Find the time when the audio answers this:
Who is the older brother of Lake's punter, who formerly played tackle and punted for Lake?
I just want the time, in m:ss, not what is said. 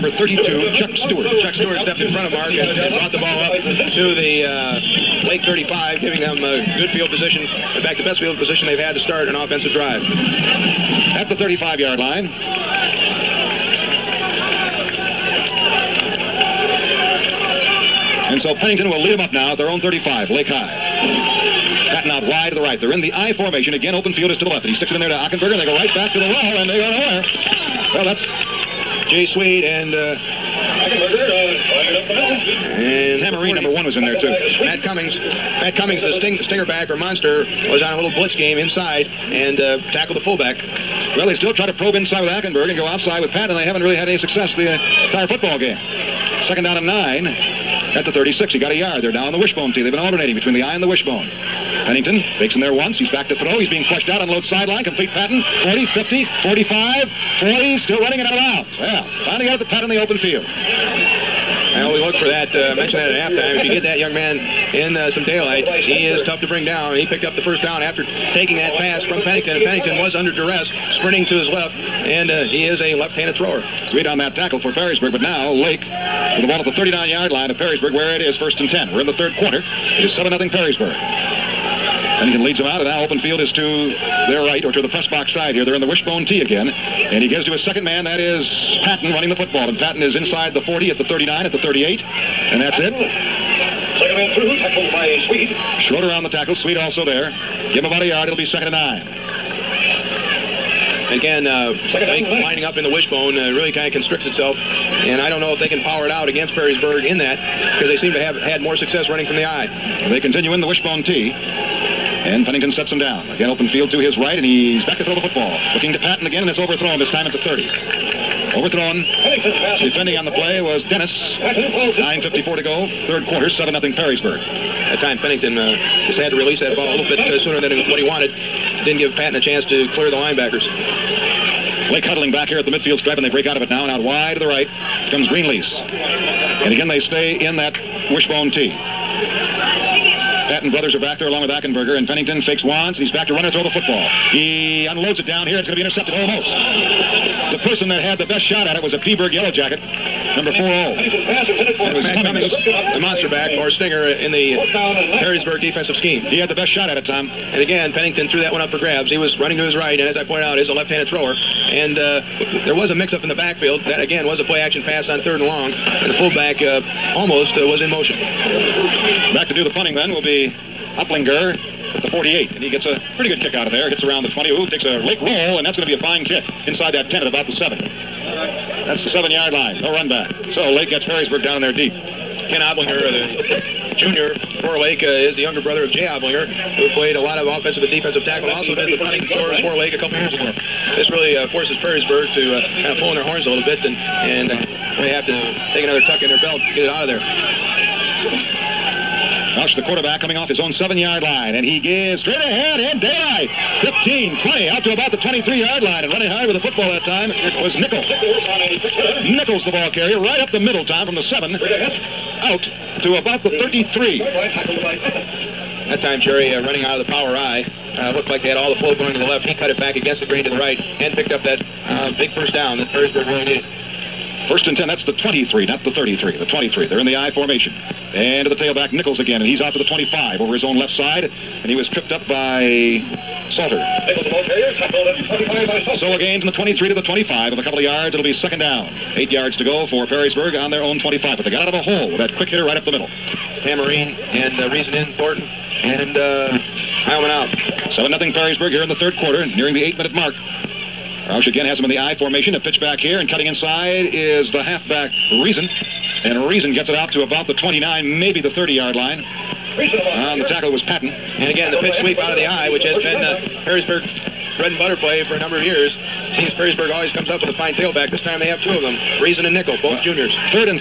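3:05.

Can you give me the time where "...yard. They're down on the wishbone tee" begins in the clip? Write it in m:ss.
0:48.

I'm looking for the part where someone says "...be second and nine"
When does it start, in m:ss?
1:38.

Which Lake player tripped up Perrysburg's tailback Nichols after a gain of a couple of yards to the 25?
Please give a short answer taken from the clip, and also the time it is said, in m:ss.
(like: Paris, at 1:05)
Salter, at 3:53.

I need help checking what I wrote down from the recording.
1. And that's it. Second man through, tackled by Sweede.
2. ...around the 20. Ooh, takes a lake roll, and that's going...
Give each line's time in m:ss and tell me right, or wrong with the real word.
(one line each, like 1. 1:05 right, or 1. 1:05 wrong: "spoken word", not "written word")
1. 1:32 right
2. 2:54 right.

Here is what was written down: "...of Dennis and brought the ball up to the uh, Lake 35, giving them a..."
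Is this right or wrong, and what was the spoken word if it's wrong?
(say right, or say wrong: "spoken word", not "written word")
wrong: "Mark", not "Dennis".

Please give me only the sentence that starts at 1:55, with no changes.
Looking to Patton again, and it's overthrown, this time at the 30.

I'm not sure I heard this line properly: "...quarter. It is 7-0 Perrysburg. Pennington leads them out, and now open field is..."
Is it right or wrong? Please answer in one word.
right.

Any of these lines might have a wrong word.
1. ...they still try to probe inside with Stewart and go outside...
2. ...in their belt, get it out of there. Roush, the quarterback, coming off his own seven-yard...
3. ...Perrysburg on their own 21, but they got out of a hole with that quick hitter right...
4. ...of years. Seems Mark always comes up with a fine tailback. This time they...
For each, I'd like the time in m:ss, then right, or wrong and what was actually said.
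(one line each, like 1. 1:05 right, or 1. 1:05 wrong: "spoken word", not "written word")
1. 0:41 wrong: "Ackenberg", not "Stewart"
2. 3:16 right
3. 4:00 wrong: "25", not "21"
4. 4:25 wrong: "Perrysburg", not "Mark".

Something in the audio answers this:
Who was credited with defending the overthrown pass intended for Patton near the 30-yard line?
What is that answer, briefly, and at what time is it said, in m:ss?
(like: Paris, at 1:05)
Dennis, at 2:00.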